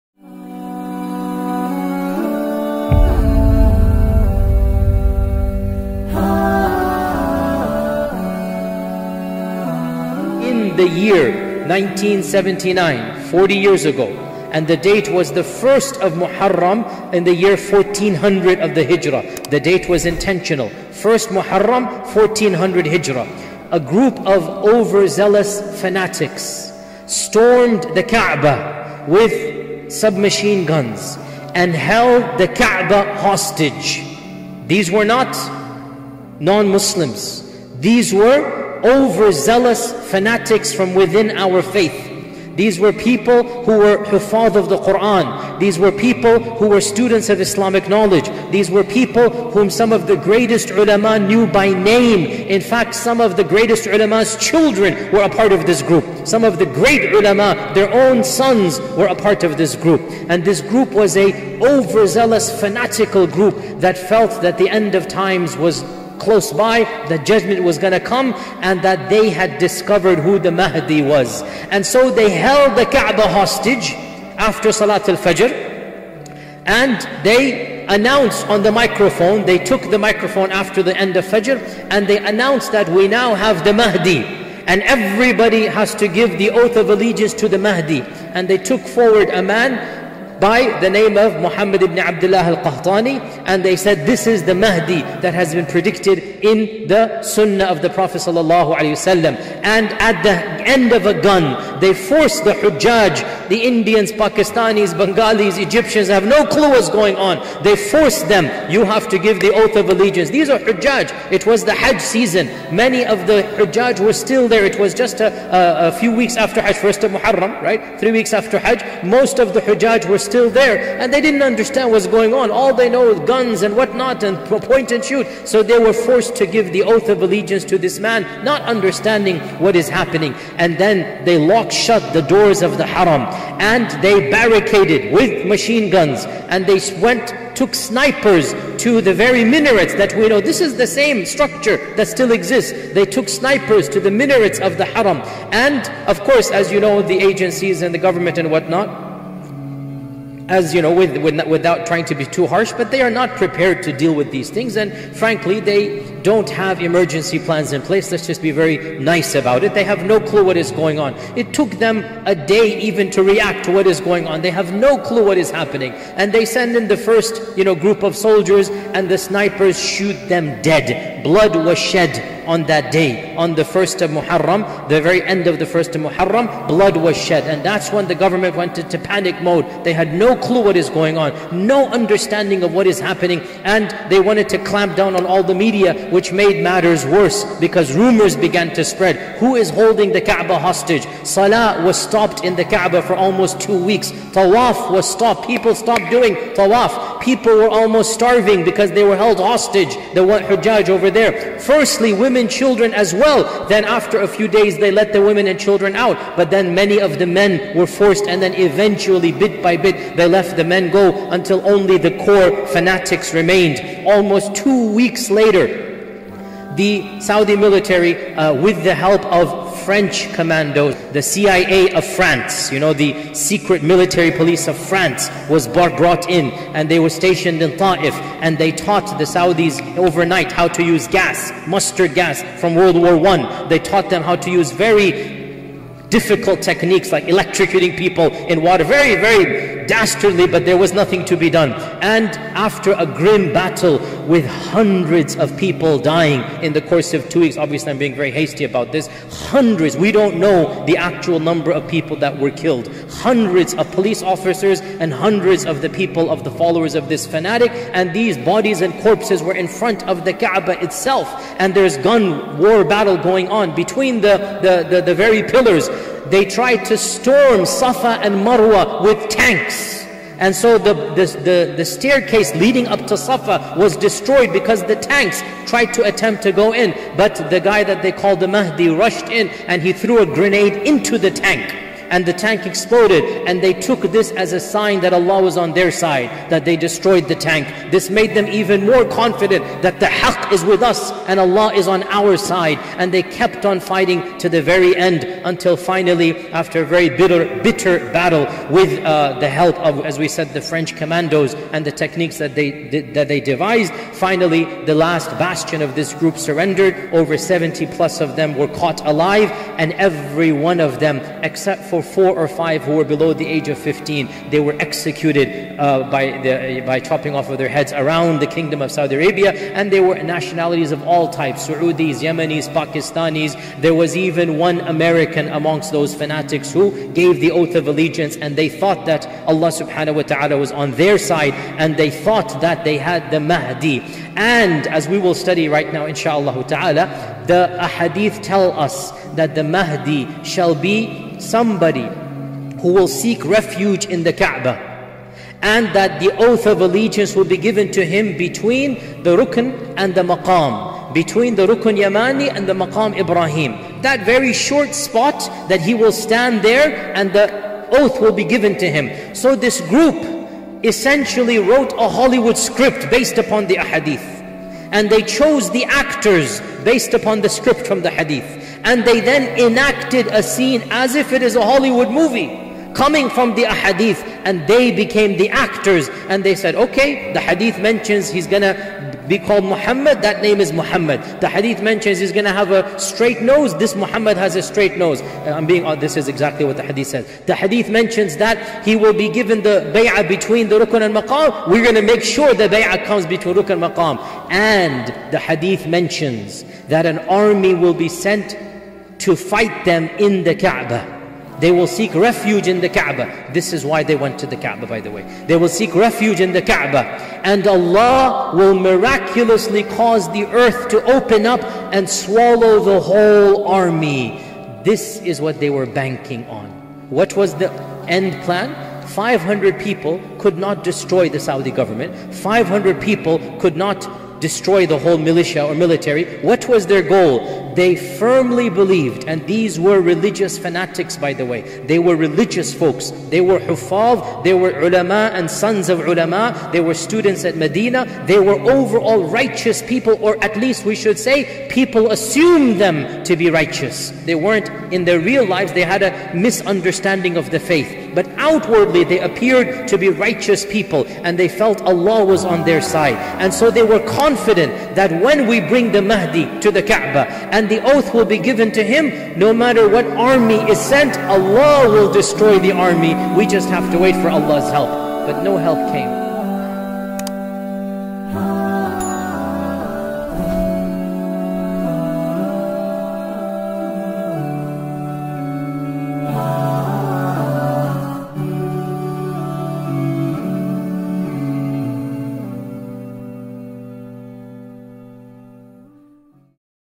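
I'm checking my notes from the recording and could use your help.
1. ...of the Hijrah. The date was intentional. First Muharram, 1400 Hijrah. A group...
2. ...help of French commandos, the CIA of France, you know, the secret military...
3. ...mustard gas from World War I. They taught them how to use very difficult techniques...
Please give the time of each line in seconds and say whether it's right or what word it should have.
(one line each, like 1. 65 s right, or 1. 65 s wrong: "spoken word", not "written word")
1. 18 s right
2. 218 s right
3. 231 s right.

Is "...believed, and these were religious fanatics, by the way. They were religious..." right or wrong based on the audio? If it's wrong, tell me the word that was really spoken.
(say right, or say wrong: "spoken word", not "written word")
right.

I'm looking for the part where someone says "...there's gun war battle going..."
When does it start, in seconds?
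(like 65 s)
261 s.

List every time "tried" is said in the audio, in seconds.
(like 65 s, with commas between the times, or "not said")
266 s, 275 s.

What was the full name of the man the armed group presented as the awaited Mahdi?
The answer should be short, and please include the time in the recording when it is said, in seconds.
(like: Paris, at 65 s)
Muhammad ibn Abdullah al-Qahtani, at 91 s.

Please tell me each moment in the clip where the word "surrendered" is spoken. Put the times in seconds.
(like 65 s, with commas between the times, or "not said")
306 s.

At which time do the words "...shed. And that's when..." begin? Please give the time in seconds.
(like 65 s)
177 s.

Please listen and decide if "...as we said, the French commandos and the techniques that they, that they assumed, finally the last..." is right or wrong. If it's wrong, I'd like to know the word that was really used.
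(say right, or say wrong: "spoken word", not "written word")
wrong: "devised", not "assumed".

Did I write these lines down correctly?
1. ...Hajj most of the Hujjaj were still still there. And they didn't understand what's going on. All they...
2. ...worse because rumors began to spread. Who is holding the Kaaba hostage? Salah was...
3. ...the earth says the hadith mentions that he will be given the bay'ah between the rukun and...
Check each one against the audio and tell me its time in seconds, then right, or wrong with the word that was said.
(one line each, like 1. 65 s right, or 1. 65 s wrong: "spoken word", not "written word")
1. 118 s right
2. 187 s right
3. 386 s wrong: "hadith", not "earth".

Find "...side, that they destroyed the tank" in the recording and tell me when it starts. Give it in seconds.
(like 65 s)
285 s.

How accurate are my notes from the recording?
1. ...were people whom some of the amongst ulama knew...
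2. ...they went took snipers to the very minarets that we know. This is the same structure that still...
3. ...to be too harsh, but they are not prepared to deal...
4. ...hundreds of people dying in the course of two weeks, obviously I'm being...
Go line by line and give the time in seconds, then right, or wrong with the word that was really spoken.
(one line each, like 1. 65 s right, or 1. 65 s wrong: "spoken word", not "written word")
1. 48 s wrong: "greatest", not "amongst"
2. 136 s right
3. 152 s right
4. 244 s right.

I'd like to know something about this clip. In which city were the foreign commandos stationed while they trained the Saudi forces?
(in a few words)
Ta'if.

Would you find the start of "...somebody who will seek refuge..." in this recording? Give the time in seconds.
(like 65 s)
341 s.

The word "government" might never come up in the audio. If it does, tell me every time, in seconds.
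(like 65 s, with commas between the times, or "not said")
147 s, 178 s, 421 s.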